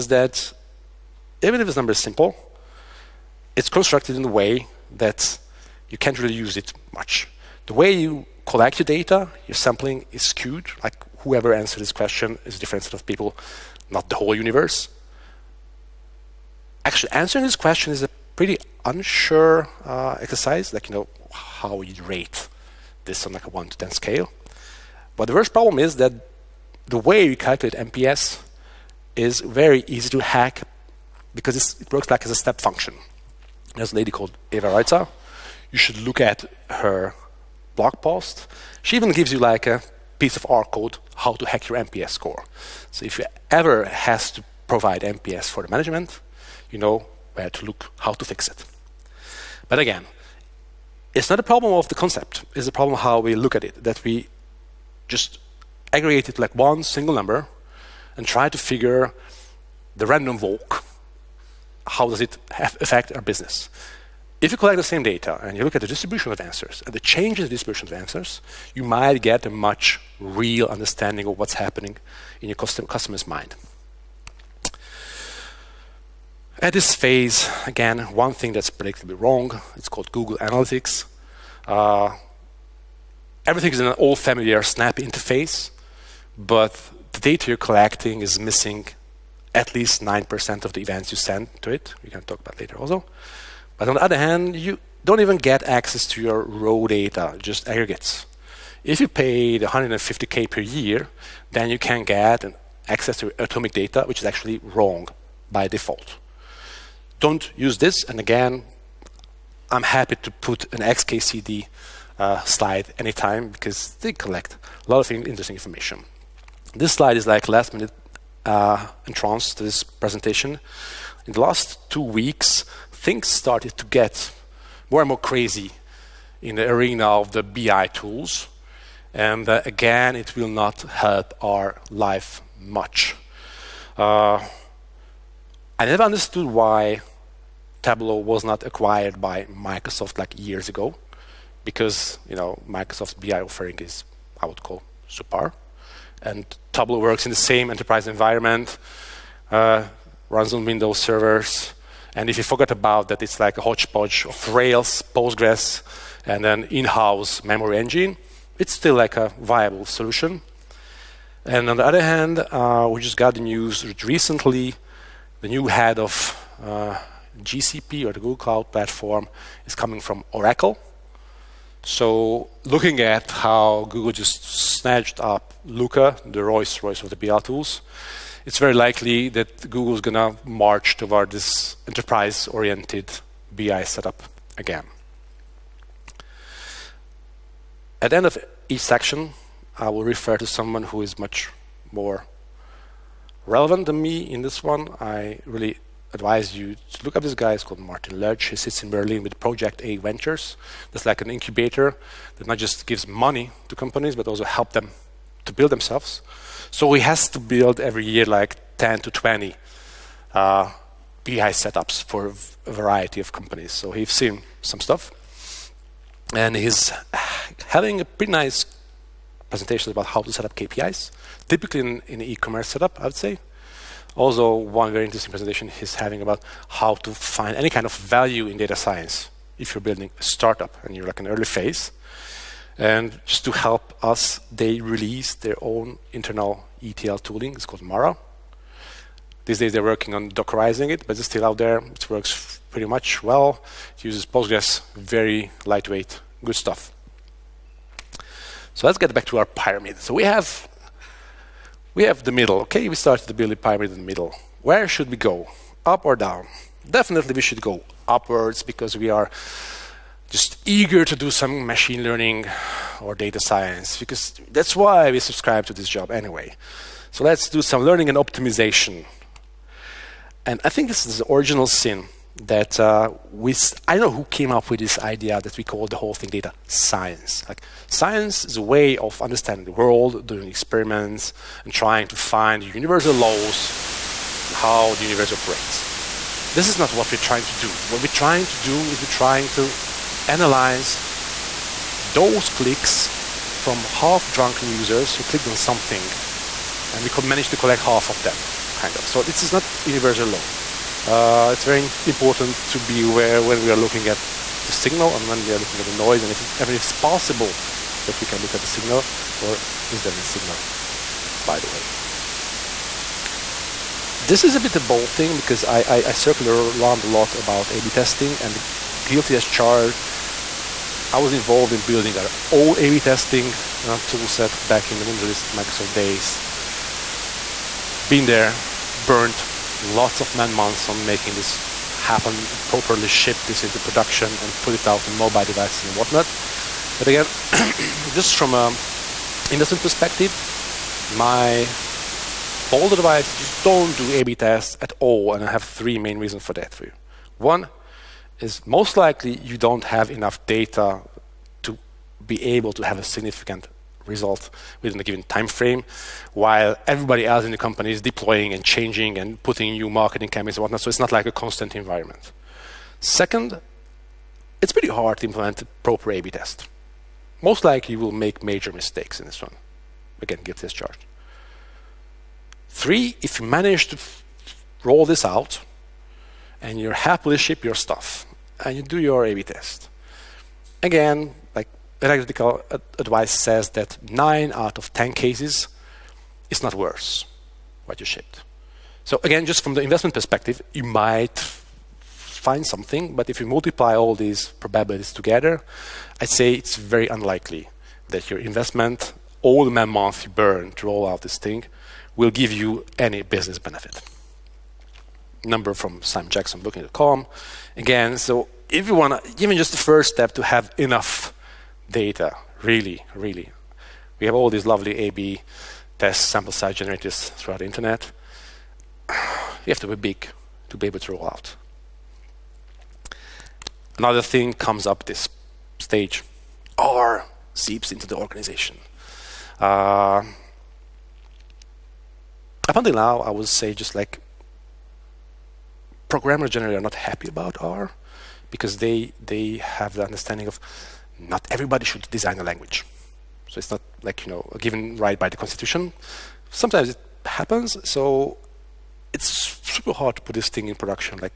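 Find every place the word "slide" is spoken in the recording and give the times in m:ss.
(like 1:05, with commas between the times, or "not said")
1:52, 1:56.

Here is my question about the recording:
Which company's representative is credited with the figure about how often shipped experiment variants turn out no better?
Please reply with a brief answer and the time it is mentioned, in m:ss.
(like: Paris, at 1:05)
booking.com, at 6:46.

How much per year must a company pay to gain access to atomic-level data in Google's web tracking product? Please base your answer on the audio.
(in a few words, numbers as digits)
150k.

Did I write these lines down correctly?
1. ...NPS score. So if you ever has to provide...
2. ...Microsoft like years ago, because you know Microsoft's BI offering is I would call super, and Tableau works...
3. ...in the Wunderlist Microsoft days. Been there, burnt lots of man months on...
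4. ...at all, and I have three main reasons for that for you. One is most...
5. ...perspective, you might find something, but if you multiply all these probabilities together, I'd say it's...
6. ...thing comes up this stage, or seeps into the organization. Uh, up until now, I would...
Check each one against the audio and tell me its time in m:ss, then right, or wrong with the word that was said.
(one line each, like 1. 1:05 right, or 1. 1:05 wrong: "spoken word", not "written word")
1. 0:41 right
2. 2:19 right
3. 5:24 right
4. 5:44 right
5. 6:30 right
6. 7:04 right.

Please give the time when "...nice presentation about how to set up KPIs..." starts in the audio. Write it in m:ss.
3:38.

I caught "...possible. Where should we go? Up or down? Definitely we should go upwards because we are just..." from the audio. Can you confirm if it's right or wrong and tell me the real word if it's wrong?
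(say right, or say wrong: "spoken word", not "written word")
wrong: "middle", not "possible".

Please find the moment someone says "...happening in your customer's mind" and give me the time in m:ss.
1:11.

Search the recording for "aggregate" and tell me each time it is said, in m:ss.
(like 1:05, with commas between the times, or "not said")
0:55, 1:37.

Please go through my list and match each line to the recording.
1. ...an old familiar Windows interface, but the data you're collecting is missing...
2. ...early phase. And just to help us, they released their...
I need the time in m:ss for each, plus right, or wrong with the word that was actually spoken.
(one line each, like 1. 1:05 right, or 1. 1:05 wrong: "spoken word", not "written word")
1. 1:23 wrong: "Snap", not "Windows"
2. 3:51 right.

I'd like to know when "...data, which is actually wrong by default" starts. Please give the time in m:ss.
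1:43.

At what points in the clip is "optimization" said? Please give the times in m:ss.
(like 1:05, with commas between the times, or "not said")
4:28.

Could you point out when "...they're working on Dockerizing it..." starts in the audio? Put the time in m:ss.
3:59.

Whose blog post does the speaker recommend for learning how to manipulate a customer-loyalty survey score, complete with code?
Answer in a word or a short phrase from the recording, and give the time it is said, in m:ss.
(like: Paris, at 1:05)
Eva Reitzer, at 0:34.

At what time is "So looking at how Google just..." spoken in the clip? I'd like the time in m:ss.
2:51.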